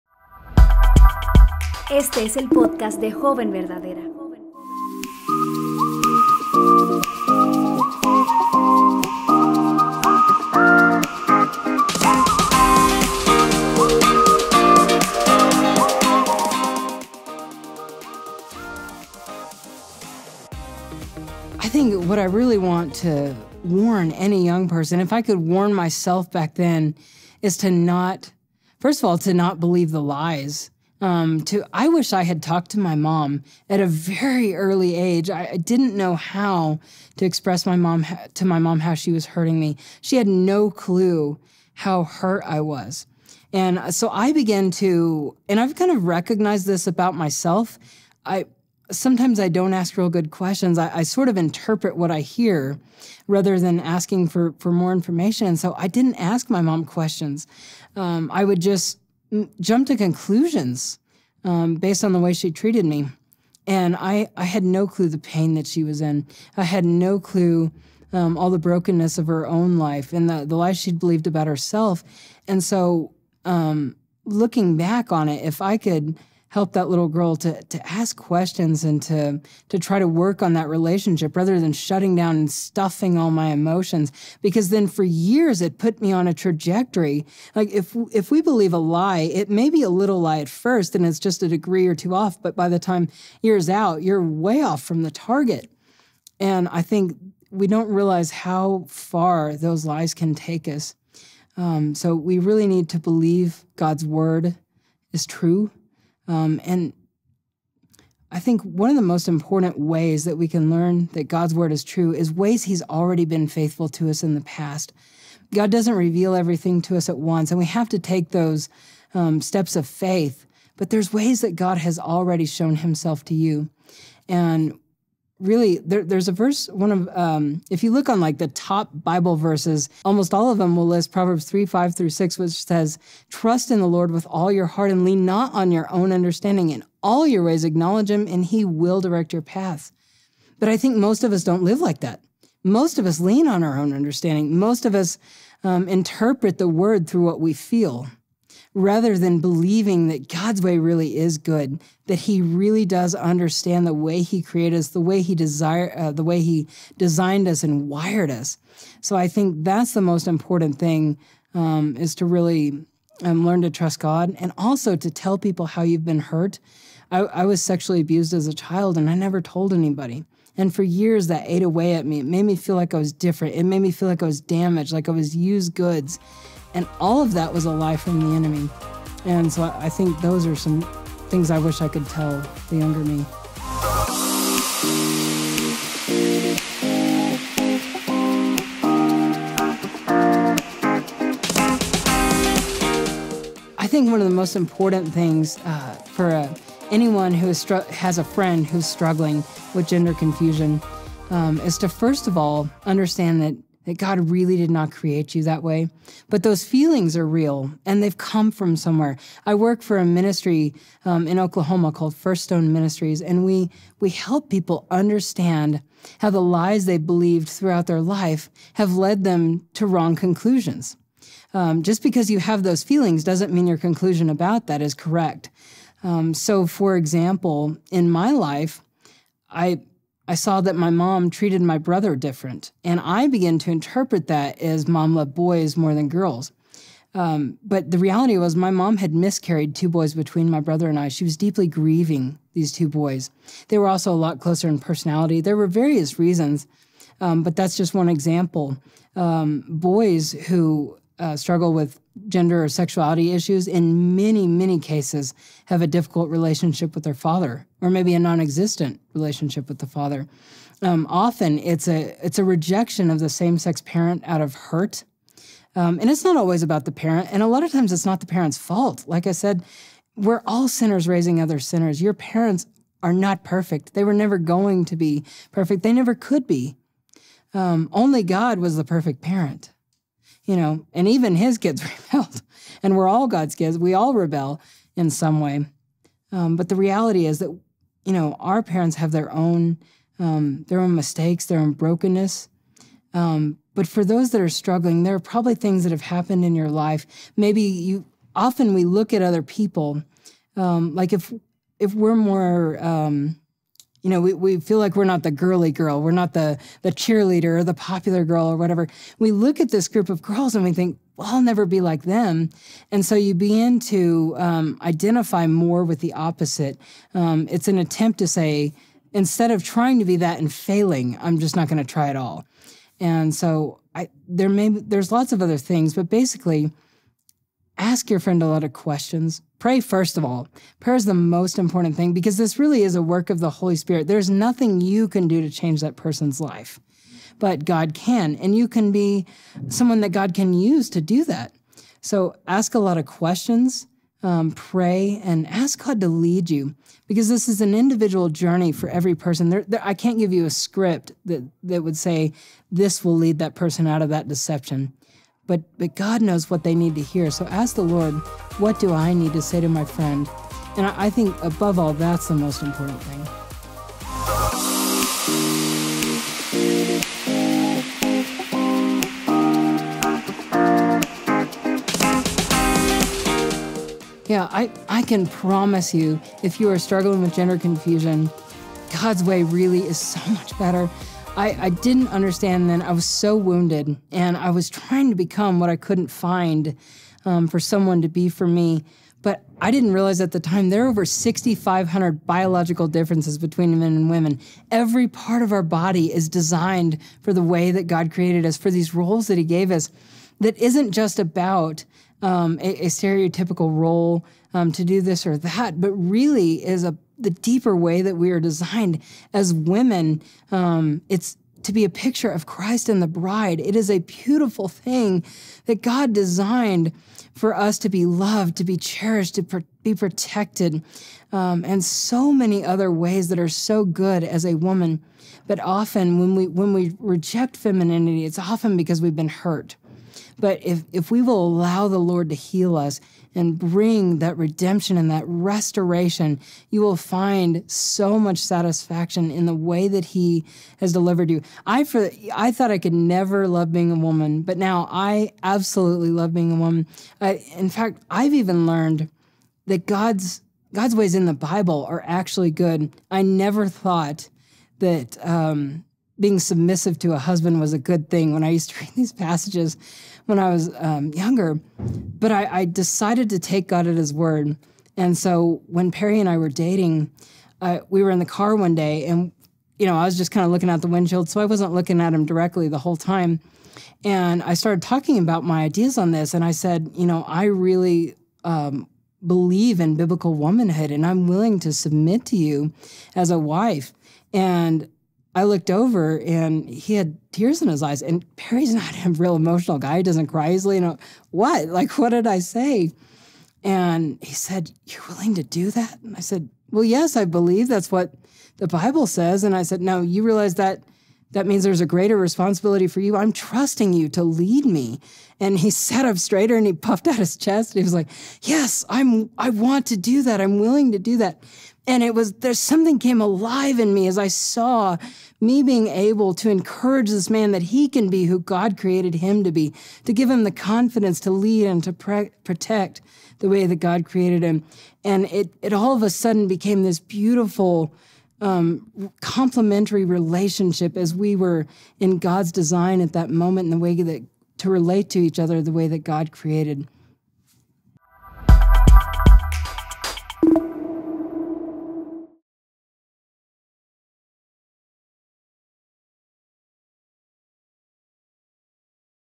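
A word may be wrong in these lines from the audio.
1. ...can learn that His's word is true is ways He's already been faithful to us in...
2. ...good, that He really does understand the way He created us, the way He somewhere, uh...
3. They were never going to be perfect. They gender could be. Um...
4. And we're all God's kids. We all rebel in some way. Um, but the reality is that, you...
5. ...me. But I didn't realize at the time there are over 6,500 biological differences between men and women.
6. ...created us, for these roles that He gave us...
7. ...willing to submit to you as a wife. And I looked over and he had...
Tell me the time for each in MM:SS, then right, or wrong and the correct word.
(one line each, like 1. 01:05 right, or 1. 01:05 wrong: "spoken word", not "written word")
1. 01:50 wrong: "God", not "His"
2. 02:31 wrong: "desire", not "somewhere"
3. 04:33 wrong: "never", not "gender"
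4. 04:42 right
5. 06:28 right
6. 06:38 right
7. 08:01 right.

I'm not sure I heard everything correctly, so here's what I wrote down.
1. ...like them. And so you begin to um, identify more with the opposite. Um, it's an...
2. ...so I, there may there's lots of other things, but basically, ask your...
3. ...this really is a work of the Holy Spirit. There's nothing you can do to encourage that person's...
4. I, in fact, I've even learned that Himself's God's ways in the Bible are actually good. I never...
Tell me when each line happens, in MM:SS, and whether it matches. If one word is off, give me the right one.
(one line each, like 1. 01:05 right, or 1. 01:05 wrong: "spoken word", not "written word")
1. 05:11 right
2. 05:23 right
3. 05:32 wrong: "change", not "encourage"
4. 07:27 wrong: "God", not "Himself".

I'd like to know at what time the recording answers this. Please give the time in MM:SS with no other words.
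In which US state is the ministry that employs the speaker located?
03:31.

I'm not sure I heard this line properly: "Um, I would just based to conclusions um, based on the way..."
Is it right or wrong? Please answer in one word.
wrong.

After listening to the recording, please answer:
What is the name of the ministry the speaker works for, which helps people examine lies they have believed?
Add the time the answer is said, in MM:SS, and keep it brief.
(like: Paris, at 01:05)
First Stone Ministries, at 03:32.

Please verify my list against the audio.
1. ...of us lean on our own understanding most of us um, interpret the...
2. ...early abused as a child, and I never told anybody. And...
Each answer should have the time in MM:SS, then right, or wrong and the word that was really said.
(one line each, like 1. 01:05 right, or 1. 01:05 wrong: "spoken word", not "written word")
1. 02:22 right
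2. 02:47 wrong: "sexually", not "early".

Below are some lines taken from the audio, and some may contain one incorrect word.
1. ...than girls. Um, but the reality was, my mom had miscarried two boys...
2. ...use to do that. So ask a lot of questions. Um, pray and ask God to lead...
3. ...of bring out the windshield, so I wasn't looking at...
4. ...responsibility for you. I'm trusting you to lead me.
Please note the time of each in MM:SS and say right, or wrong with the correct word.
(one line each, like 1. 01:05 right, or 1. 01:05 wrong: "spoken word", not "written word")
1. 03:55 right
2. 05:40 right
3. 07:50 wrong: "looking", not "bring"
4. 08:22 right.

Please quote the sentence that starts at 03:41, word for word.
Um, just because you have those feelings doesn't mean your conclusion about that is correct.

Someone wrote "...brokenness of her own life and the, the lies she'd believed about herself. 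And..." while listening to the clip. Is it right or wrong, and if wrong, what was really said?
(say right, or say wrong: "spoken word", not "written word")
right.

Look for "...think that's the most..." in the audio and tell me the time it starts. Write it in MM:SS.
02:39.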